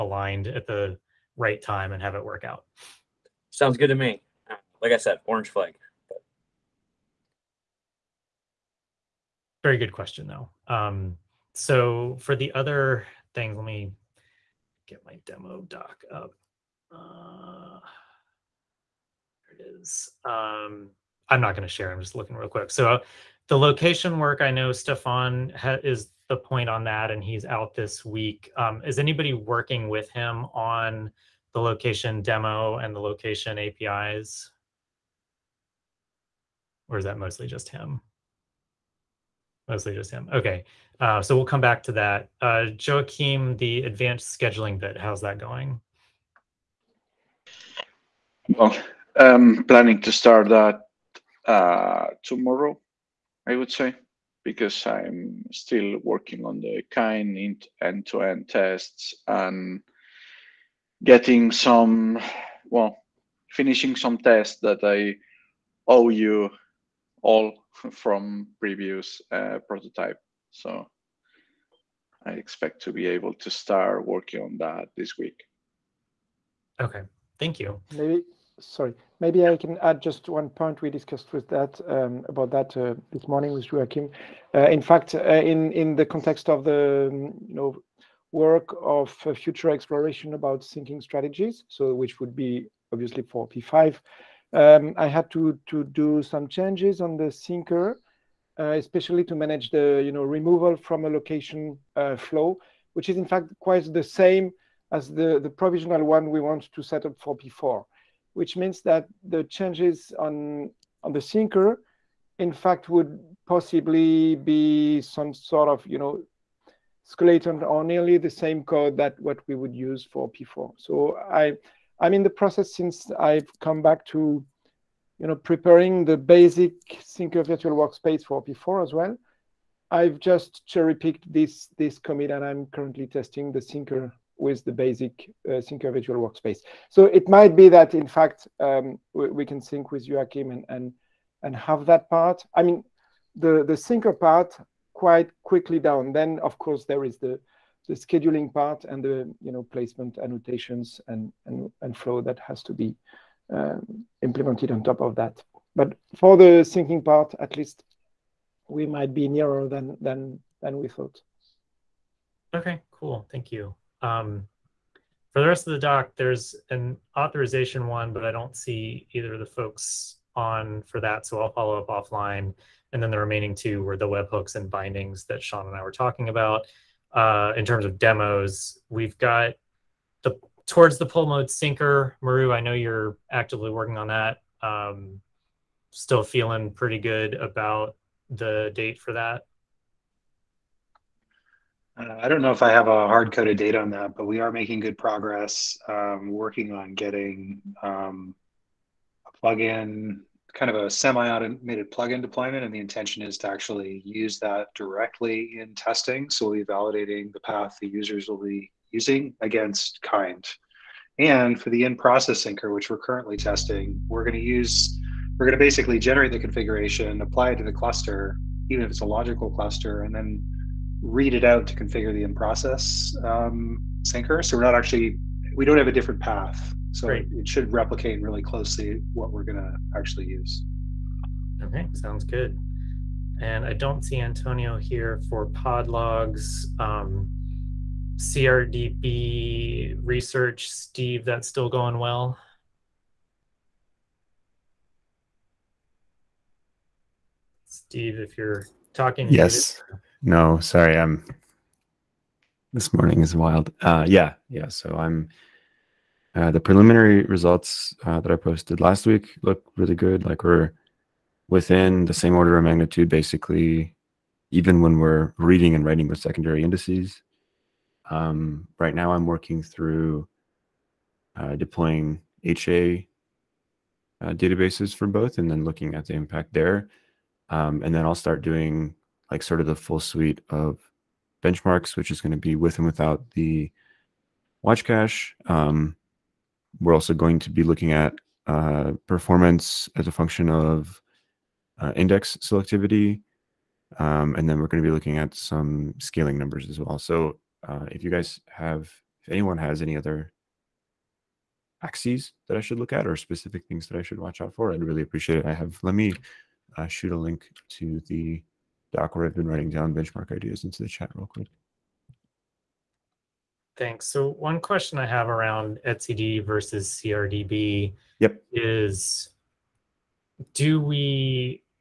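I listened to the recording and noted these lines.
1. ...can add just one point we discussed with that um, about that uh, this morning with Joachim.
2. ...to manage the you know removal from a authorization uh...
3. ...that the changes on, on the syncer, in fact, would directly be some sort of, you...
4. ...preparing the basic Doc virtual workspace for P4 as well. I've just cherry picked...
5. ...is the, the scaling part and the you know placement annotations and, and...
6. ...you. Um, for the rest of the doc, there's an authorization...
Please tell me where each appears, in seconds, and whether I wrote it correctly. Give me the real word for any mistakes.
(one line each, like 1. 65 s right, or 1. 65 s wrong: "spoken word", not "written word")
1. 79 s right
2. 99 s wrong: "location", not "authorization"
3. 108 s wrong: "possibly", not "directly"
4. 125 s wrong: "Syncer", not "Doc"
5. 147 s wrong: "scheduling", not "scaling"
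6. 163 s right.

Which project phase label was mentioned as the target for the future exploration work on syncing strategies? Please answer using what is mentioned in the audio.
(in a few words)
P5.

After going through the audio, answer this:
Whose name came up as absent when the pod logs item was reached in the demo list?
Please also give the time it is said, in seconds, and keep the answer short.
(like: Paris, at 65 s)
Antonio, at 234 s.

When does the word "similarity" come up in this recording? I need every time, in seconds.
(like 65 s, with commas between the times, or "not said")
not said.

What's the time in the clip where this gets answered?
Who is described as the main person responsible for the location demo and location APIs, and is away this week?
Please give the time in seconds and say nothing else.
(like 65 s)
24 s.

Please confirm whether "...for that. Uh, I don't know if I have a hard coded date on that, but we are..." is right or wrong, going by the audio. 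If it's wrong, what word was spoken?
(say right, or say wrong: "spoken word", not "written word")
right.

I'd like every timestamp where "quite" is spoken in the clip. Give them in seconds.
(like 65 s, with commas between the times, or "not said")
103 s, 144 s.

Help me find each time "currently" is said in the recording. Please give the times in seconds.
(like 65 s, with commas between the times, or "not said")
132 s, 212 s.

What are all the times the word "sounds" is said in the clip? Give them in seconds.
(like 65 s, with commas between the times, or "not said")
3 s, 231 s.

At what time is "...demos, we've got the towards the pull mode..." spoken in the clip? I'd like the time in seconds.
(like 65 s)
177 s.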